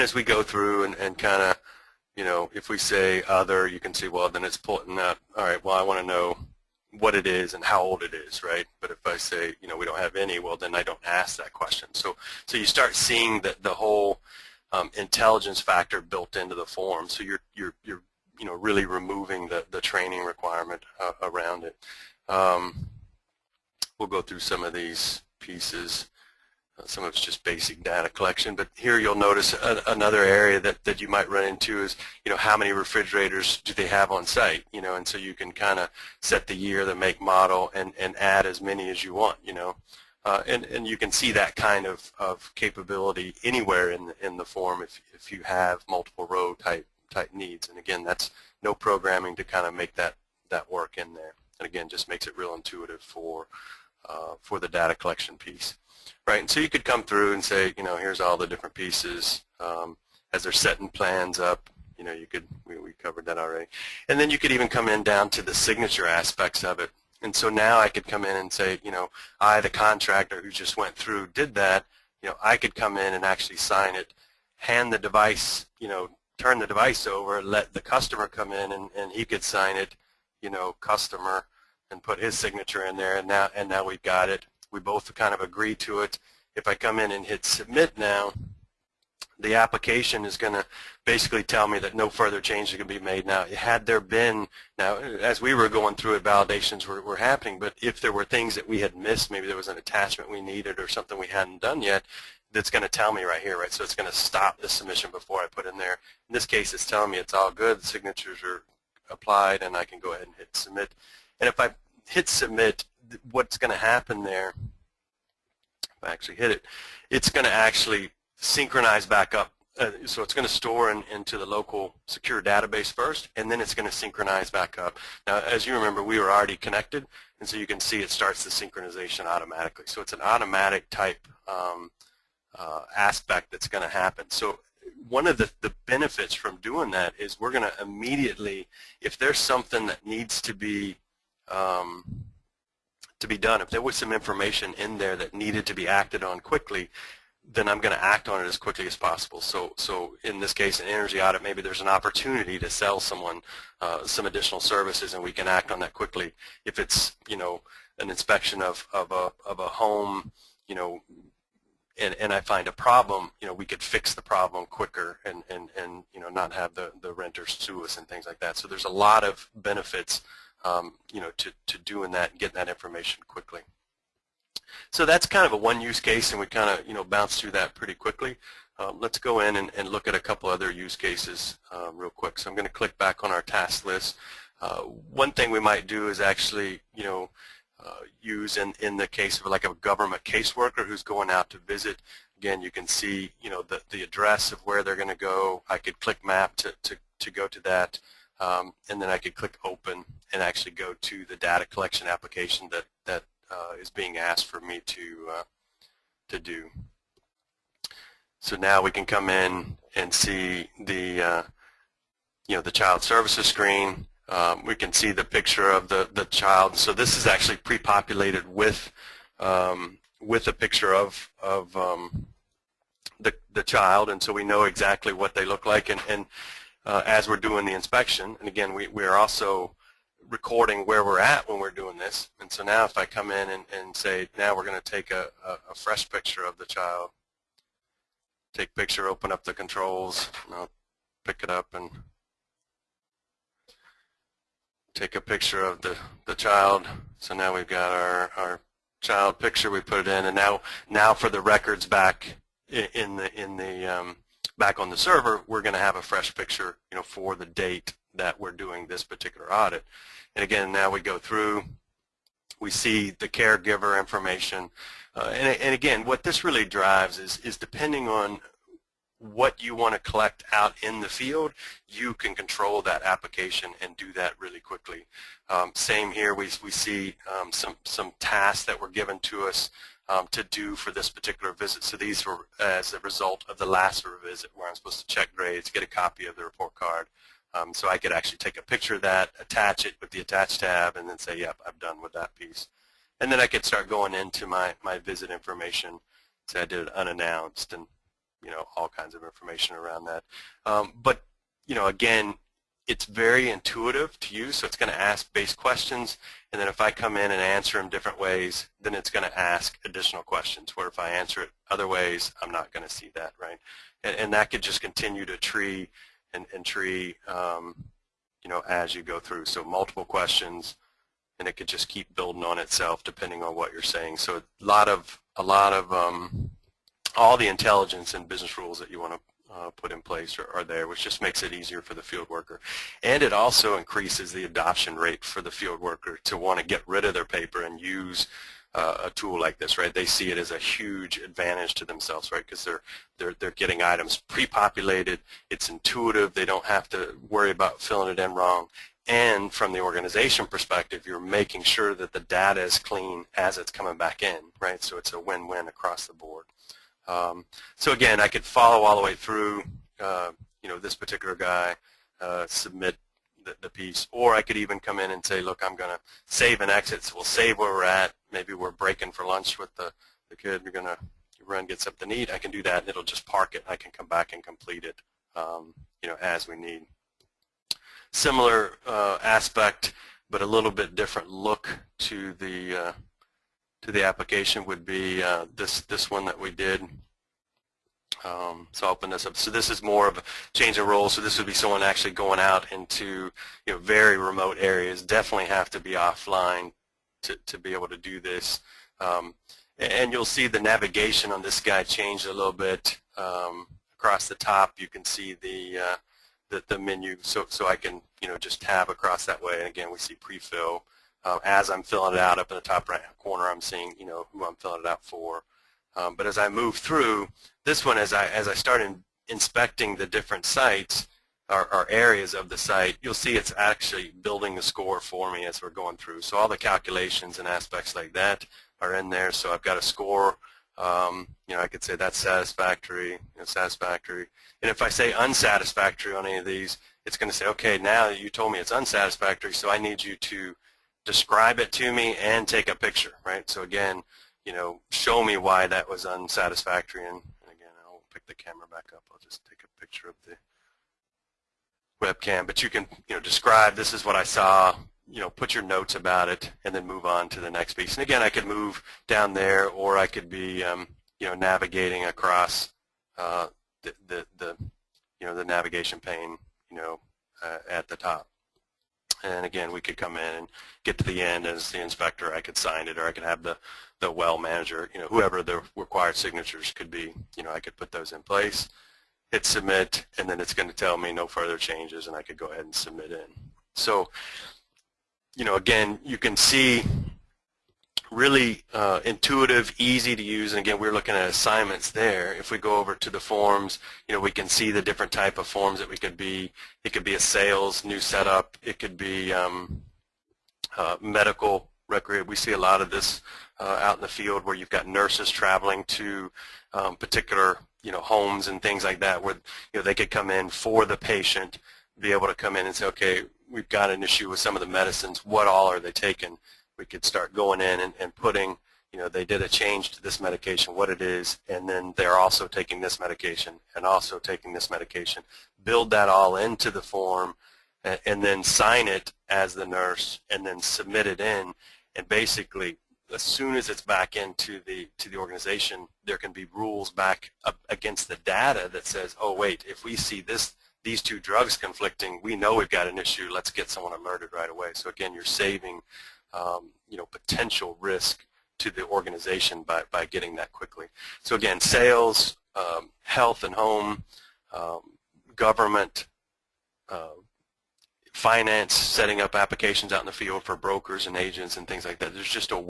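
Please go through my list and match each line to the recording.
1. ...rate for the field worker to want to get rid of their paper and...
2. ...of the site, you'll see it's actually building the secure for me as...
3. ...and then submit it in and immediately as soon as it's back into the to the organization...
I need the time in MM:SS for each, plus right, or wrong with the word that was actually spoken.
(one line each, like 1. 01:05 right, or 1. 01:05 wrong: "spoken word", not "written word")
1. 05:34 right
2. 07:02 wrong: "score", not "secure"
3. 08:50 wrong: "basically", not "immediately".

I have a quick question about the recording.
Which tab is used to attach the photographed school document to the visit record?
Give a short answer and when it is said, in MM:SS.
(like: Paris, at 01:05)
attach tab, at 04:50.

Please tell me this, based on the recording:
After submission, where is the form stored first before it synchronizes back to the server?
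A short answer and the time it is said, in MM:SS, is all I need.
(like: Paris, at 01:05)
local secure database, at 02:01.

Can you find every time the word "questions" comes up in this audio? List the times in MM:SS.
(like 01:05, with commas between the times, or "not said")
00:11, 05:05, 05:10, 05:20.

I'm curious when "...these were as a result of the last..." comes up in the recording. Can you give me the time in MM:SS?
04:41.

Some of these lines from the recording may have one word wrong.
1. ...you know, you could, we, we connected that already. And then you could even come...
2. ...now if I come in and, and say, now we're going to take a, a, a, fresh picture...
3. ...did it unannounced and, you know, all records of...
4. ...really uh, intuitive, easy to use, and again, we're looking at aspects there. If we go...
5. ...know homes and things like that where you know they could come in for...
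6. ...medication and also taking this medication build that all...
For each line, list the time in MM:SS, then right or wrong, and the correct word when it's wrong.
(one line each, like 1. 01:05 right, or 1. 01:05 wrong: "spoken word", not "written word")
1. 01:01 wrong: "covered", not "connected"
2. 03:52 right
3. 04:56 wrong: "kinds", not "records"
4. 08:08 wrong: "assignments", not "aspects"
5. 08:27 right
6. 08:43 right.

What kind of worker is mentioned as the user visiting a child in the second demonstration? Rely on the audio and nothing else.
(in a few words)
government caseworker.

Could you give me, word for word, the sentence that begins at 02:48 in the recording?
So there's a lot of benefits, um, you know, to to doing that and getting that information quickly.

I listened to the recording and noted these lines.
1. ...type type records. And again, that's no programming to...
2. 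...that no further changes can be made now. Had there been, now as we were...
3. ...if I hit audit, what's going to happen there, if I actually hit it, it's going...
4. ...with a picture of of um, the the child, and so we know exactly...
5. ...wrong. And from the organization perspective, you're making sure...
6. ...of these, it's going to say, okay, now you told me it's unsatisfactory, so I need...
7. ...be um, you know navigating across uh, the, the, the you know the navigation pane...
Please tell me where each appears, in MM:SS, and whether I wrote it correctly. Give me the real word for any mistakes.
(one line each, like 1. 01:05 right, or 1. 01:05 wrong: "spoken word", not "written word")
1. 00:46 wrong: "needs", not "records"
2. 01:31 right
3. 01:51 wrong: "submit", not "audit"
4. 03:40 right
5. 05:48 right
6. 07:16 right
7. 07:40 right.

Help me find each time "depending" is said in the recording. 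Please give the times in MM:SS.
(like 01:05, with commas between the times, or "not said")
04:27, 05:23.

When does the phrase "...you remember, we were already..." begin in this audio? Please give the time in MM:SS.
02:05.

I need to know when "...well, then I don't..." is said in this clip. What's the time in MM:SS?
00:10.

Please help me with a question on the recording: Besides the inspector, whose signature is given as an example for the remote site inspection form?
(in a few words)
the well manager.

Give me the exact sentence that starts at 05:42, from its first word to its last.
Because they're they're they're getting items pre-populated.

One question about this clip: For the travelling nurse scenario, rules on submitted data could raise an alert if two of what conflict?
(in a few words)
drugs.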